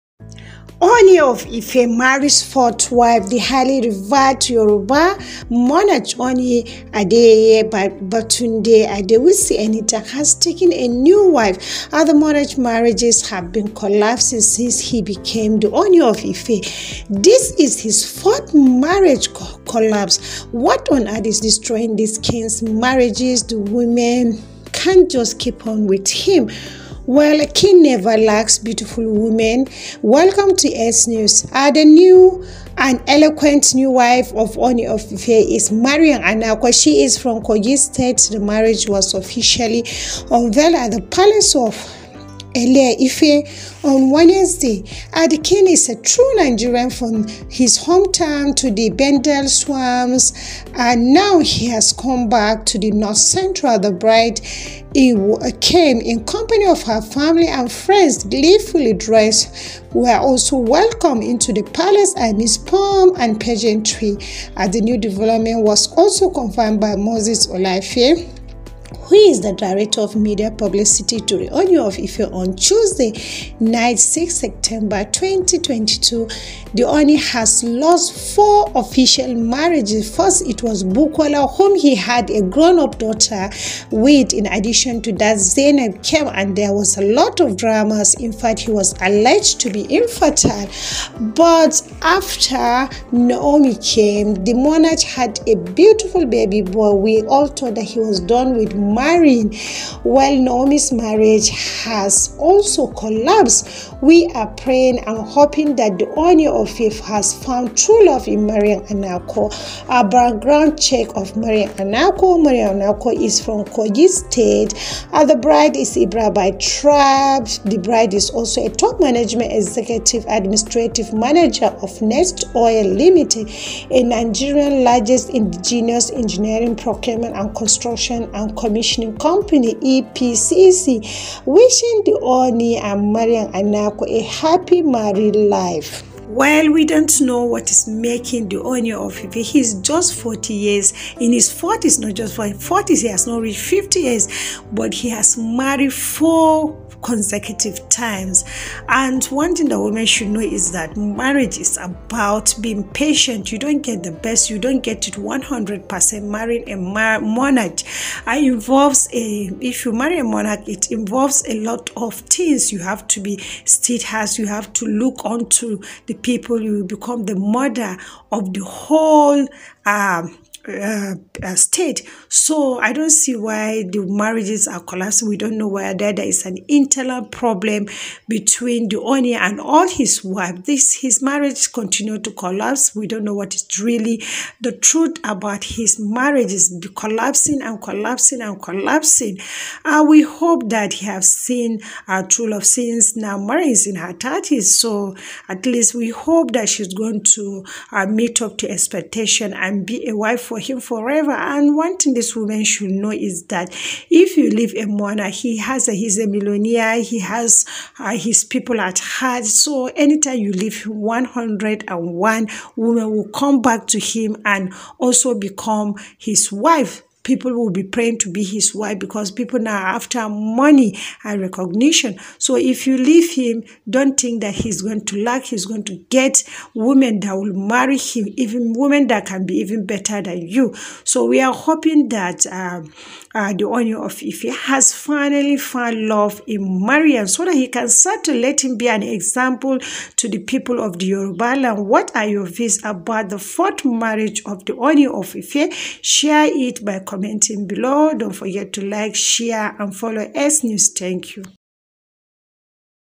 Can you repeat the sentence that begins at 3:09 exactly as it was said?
Uh, we hope that he have seen a true love since now Mary is in her thirties.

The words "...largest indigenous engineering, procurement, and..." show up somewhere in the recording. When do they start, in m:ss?
2:04.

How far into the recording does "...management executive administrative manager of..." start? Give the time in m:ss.
1:59.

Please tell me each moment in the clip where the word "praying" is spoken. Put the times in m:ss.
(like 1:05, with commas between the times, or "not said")
1:44, 3:37.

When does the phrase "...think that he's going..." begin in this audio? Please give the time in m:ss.
3:44.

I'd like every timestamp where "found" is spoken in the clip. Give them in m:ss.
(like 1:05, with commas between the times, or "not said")
1:47, 3:55.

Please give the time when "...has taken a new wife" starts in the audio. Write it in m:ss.
0:10.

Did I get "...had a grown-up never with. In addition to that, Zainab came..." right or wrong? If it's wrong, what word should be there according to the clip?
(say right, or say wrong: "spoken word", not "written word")
wrong: "daughter", not "never".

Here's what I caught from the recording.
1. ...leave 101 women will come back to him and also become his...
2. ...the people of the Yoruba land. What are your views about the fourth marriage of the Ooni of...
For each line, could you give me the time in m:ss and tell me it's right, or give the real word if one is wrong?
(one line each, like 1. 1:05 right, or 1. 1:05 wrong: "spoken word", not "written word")
1. 3:30 right
2. 4:00 right.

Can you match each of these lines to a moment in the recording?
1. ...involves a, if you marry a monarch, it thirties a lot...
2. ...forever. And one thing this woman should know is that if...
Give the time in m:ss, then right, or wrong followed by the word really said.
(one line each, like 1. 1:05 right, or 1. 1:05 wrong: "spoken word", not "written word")
1. 2:38 wrong: "involves", not "thirties"
2. 3:20 right.